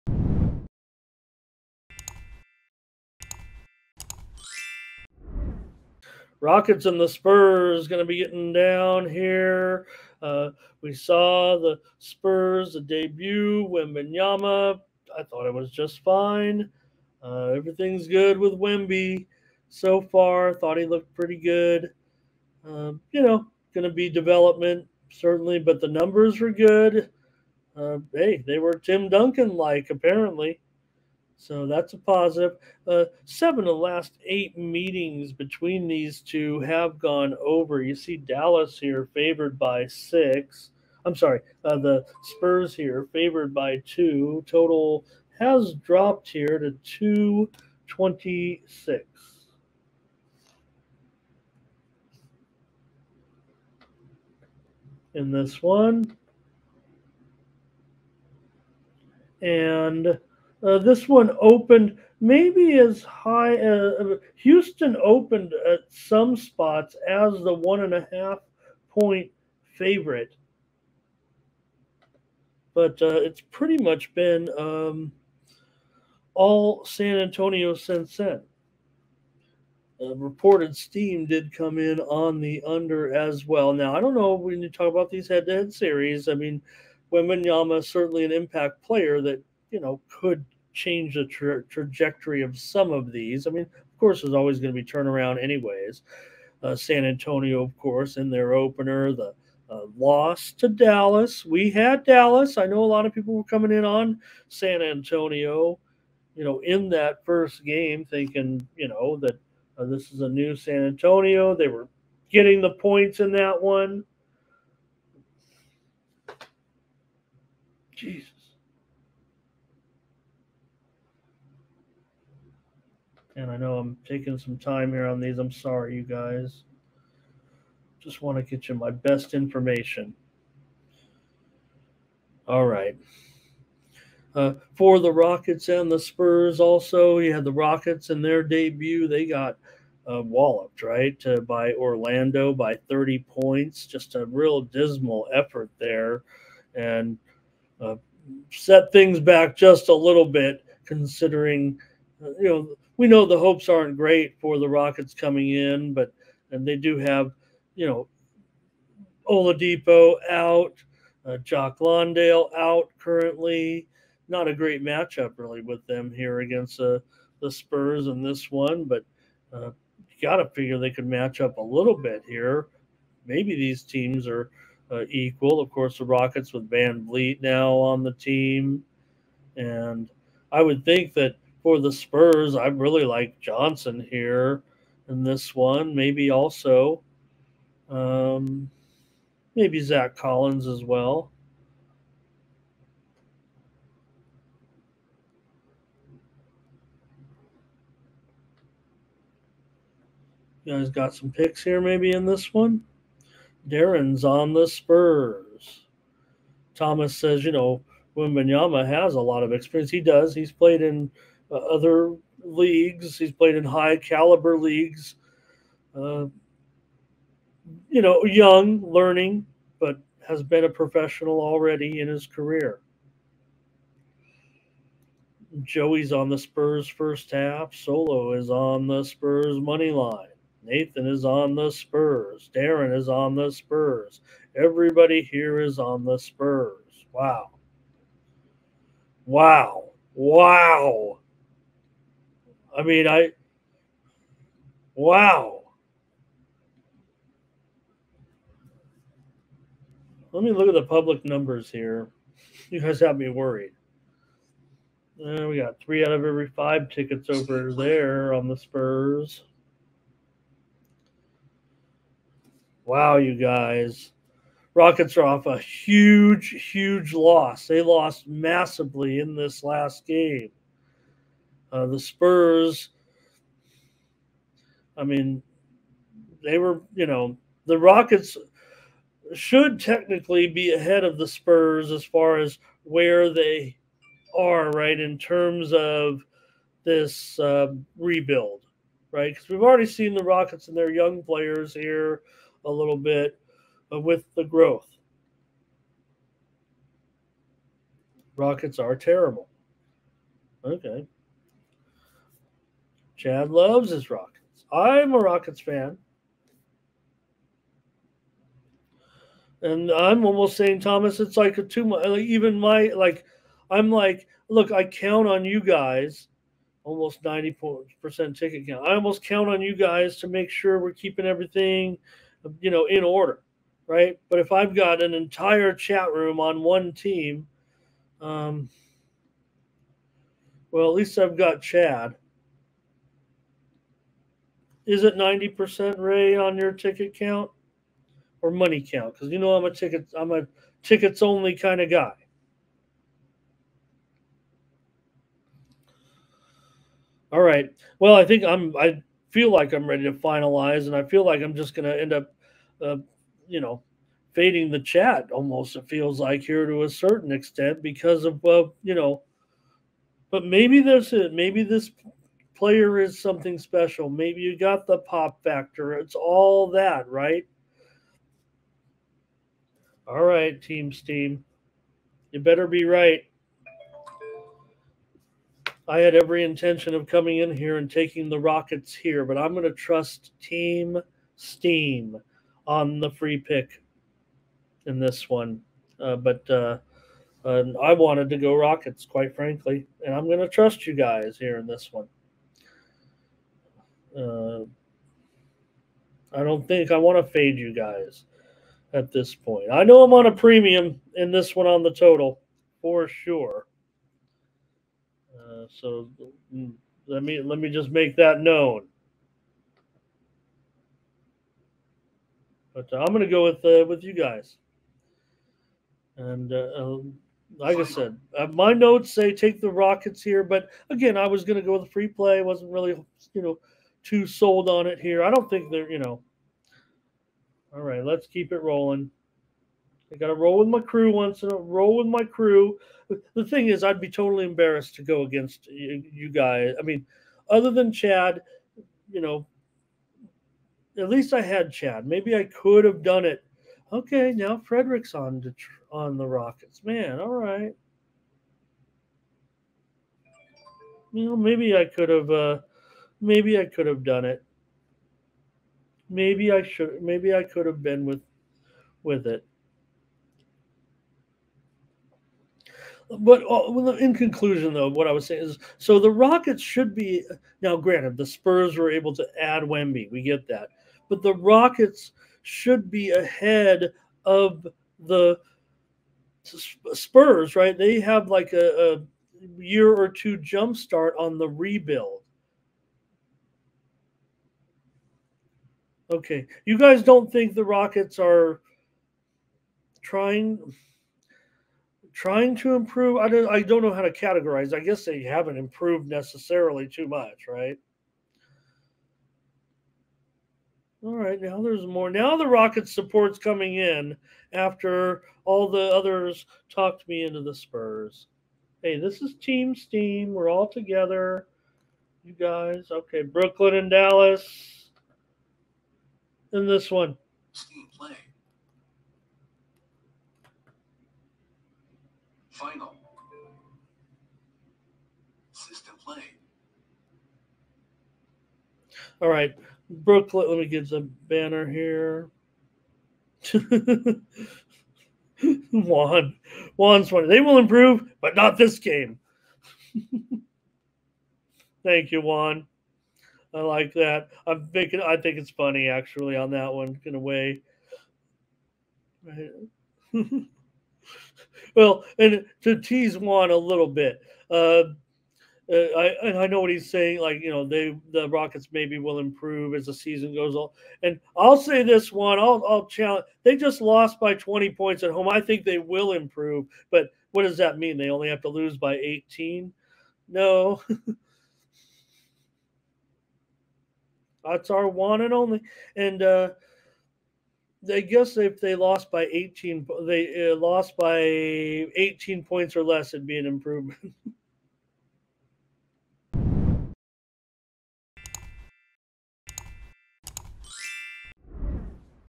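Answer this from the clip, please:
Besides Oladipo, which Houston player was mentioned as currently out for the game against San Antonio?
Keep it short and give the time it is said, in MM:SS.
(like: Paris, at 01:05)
Jock Landale, at 02:41.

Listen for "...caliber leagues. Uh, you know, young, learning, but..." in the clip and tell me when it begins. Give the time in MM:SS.
03:33.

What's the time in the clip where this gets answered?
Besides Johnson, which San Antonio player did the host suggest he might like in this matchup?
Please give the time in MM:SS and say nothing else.
03:09.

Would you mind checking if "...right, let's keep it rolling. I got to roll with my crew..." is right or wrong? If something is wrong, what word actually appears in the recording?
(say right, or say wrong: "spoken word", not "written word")
right.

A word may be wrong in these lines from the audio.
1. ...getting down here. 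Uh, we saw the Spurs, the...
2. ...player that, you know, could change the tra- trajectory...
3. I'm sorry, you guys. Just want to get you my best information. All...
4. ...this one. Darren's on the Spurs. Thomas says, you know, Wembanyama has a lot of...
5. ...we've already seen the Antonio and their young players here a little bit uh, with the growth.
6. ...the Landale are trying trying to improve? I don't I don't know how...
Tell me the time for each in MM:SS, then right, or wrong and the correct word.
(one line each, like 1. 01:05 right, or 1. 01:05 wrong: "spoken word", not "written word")
1. 00:08 right
2. 01:28 right
3. 02:05 right
4. 03:22 right
5. 04:49 wrong: "Rockets", not "Antonio"
6. 08:07 wrong: "Rockets", not "Landale".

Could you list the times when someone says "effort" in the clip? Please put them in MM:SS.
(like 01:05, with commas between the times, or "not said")
02:25.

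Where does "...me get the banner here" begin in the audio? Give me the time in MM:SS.
08:50.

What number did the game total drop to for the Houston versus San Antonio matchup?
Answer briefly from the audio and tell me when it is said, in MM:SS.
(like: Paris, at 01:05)
226, at 00:46.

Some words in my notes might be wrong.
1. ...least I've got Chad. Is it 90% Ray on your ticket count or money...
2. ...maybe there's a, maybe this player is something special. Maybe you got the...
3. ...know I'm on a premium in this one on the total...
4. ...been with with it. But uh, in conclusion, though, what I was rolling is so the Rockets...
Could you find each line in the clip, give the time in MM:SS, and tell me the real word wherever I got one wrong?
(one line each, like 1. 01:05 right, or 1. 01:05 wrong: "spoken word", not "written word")
1. 05:30 right
2. 06:00 right
3. 06:39 right
4. 07:37 wrong: "saying", not "rolling".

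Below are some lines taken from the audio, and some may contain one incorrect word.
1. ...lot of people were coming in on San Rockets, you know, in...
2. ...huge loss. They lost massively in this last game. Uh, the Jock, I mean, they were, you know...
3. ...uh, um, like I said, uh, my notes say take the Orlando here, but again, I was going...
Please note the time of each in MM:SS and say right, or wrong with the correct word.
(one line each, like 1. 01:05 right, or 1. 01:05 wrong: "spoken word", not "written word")
1. 01:42 wrong: "Antonio", not "Rockets"
2. 04:26 wrong: "Spurs", not "Jock"
3. 06:56 wrong: "Rockets", not "Orlando".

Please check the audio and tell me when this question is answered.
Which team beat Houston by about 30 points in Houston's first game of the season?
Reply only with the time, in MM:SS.
02:21.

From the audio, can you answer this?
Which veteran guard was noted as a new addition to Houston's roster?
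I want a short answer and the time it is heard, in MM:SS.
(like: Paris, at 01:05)
VanVleet, at 02:56.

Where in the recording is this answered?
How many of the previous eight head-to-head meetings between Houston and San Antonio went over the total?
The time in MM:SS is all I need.
00:33.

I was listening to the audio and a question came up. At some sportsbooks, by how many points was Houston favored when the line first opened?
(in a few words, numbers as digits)
1.5.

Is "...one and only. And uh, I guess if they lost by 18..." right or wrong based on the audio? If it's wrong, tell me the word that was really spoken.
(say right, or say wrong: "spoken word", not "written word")
right.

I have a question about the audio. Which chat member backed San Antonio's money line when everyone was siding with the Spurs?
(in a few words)
Solo.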